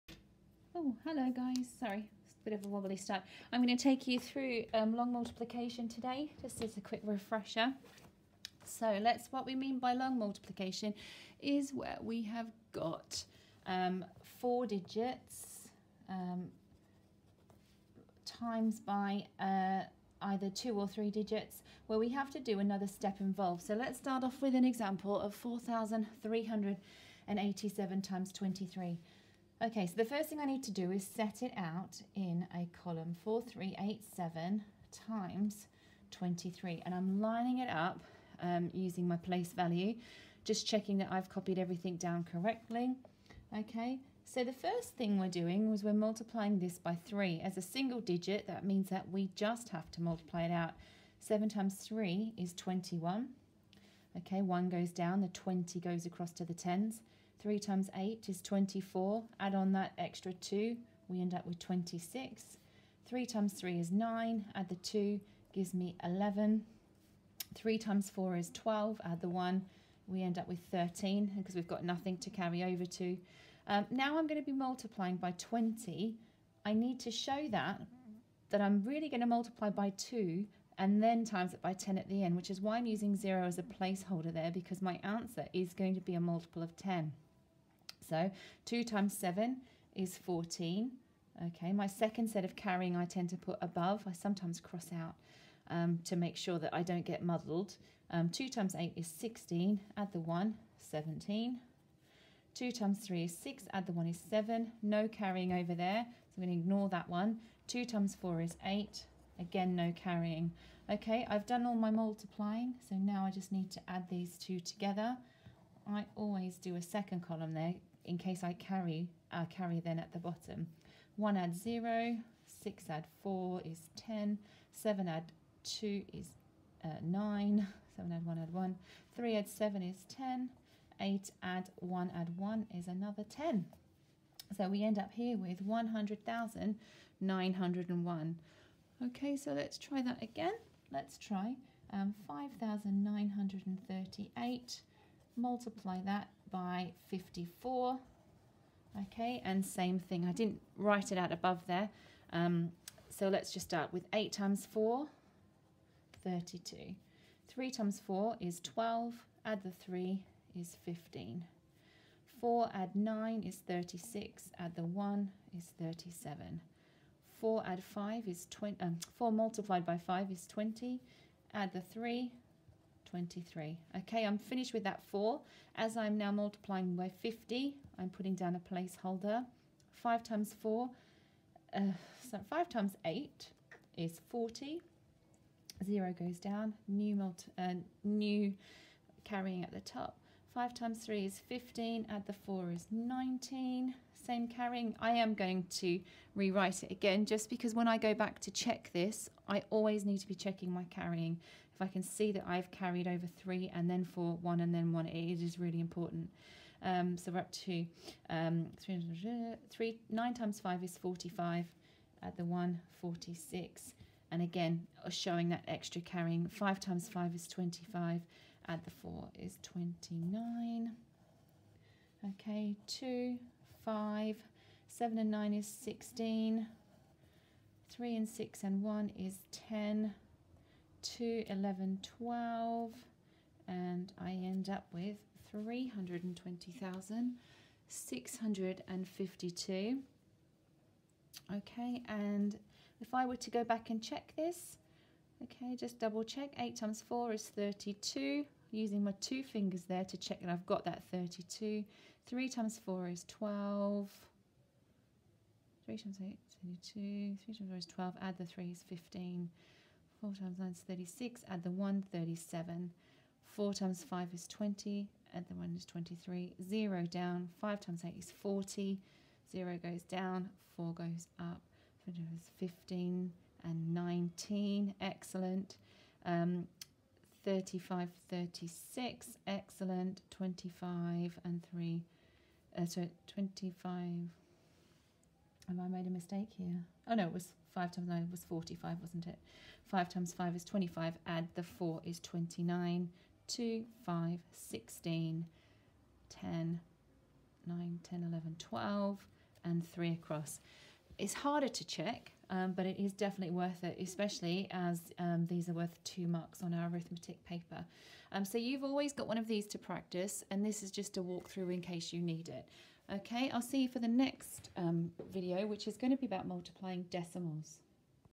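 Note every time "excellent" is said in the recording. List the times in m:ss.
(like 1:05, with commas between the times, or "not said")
4:35, 4:39.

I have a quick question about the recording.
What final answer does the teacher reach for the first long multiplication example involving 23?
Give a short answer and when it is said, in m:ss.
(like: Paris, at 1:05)
100,901, at 2:15.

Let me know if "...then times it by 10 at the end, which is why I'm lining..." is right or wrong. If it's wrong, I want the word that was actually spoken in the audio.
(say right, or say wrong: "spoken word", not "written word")
wrong: "using", not "lining".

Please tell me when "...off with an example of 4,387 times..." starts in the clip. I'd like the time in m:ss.
0:24.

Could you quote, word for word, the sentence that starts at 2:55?
As I'm now multiplying by 50, I'm putting down a placeholder.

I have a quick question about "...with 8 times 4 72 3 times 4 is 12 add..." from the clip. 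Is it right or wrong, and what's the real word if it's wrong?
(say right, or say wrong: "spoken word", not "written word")
wrong: "32", not "72".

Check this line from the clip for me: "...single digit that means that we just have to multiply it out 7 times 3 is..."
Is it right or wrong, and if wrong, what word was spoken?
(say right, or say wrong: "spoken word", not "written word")
right.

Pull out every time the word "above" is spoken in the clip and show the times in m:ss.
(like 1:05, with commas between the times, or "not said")
1:33, 2:31.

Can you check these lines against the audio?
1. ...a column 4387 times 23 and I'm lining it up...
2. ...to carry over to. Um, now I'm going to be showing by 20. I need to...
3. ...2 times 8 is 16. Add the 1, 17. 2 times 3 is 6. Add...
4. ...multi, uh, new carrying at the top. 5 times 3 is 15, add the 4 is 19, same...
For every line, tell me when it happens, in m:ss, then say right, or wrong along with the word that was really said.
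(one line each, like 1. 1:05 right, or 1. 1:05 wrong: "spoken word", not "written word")
1. 0:32 right
2. 1:12 wrong: "multiplying", not "showing"
3. 1:38 right
4. 3:07 right.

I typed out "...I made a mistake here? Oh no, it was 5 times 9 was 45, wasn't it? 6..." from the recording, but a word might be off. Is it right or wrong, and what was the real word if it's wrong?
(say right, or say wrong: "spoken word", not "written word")
wrong: "5", not "6".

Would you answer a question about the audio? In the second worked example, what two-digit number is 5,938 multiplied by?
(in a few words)
54.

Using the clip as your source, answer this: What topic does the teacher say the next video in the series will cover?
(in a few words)
multiplying decimals.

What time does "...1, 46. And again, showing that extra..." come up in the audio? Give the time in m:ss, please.
3:32.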